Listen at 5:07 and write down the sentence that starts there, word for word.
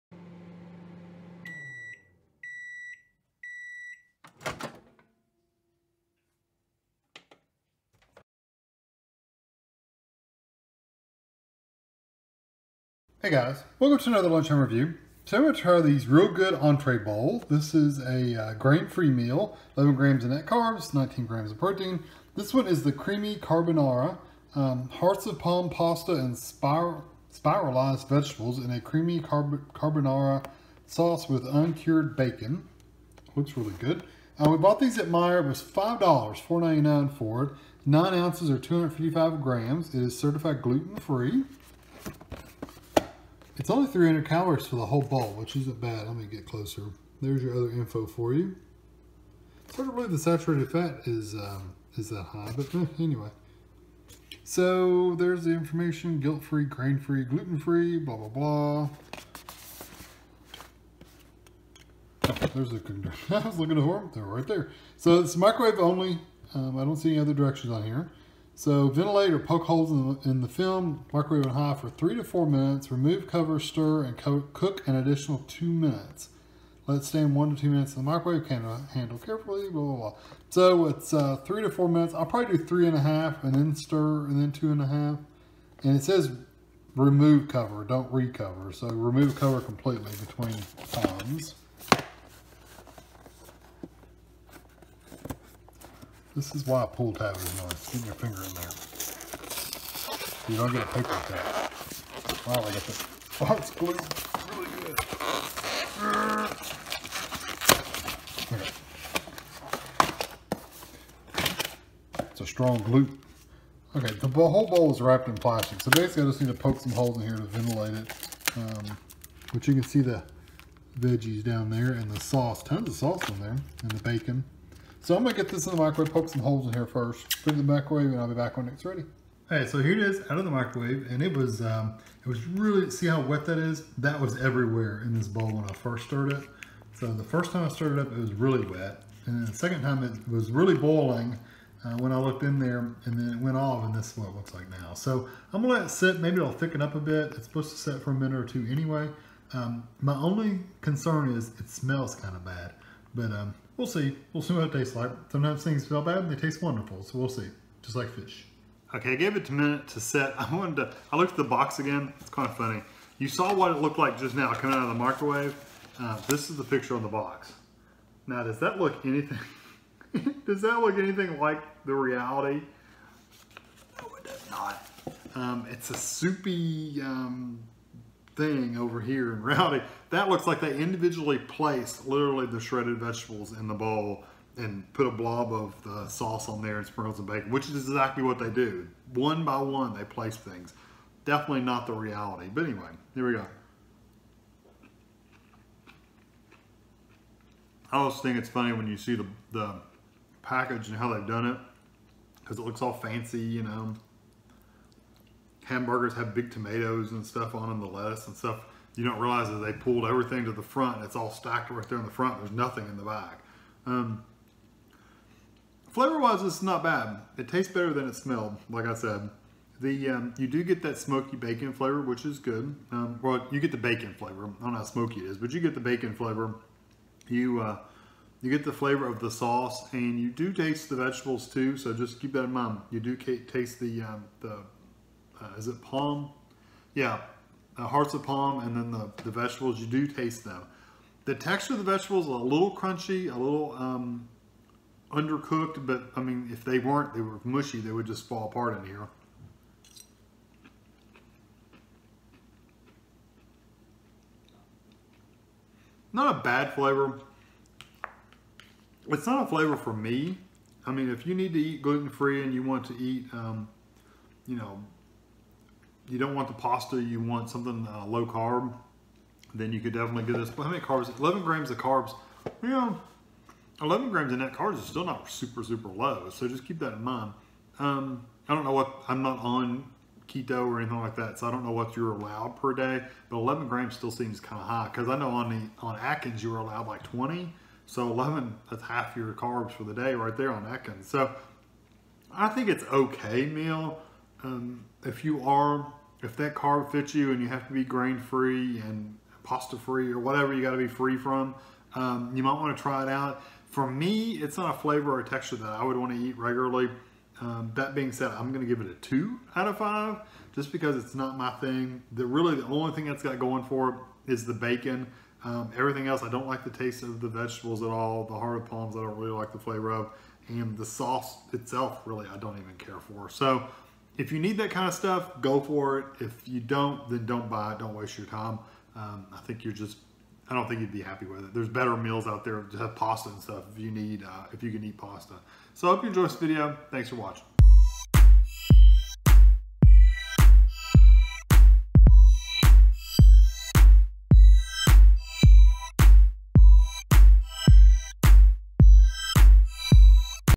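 Um, that being said, I'm going to give it a two out of five just because it's not my thing.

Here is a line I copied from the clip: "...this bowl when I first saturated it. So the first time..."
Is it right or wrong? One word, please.
wrong.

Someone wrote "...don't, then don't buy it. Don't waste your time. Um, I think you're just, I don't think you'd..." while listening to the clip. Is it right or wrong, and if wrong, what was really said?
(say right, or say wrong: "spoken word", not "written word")
right.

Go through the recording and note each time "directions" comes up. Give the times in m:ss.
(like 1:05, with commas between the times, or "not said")
1:07.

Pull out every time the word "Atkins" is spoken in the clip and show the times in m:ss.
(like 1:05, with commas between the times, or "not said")
4:45, 4:50.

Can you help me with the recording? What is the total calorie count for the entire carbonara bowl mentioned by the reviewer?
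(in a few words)
300.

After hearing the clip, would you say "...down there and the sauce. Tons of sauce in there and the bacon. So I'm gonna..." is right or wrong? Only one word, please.
right.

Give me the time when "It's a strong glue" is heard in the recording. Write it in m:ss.
1:52.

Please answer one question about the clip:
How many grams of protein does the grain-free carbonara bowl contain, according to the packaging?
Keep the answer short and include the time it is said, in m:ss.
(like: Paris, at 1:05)
19 grams, at 0:20.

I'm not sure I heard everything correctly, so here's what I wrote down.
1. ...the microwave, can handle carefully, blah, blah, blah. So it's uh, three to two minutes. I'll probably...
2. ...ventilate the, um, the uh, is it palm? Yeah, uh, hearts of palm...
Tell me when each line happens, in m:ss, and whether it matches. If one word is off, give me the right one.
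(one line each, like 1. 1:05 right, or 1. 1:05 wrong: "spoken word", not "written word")
1. 1:18 wrong: "four", not "two"
2. 3:53 wrong: "taste", not "ventilate".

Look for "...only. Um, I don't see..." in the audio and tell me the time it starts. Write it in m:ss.
1:05.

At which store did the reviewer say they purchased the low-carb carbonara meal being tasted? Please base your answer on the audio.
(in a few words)
Meijer.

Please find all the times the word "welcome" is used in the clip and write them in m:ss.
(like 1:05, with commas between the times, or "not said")
0:13.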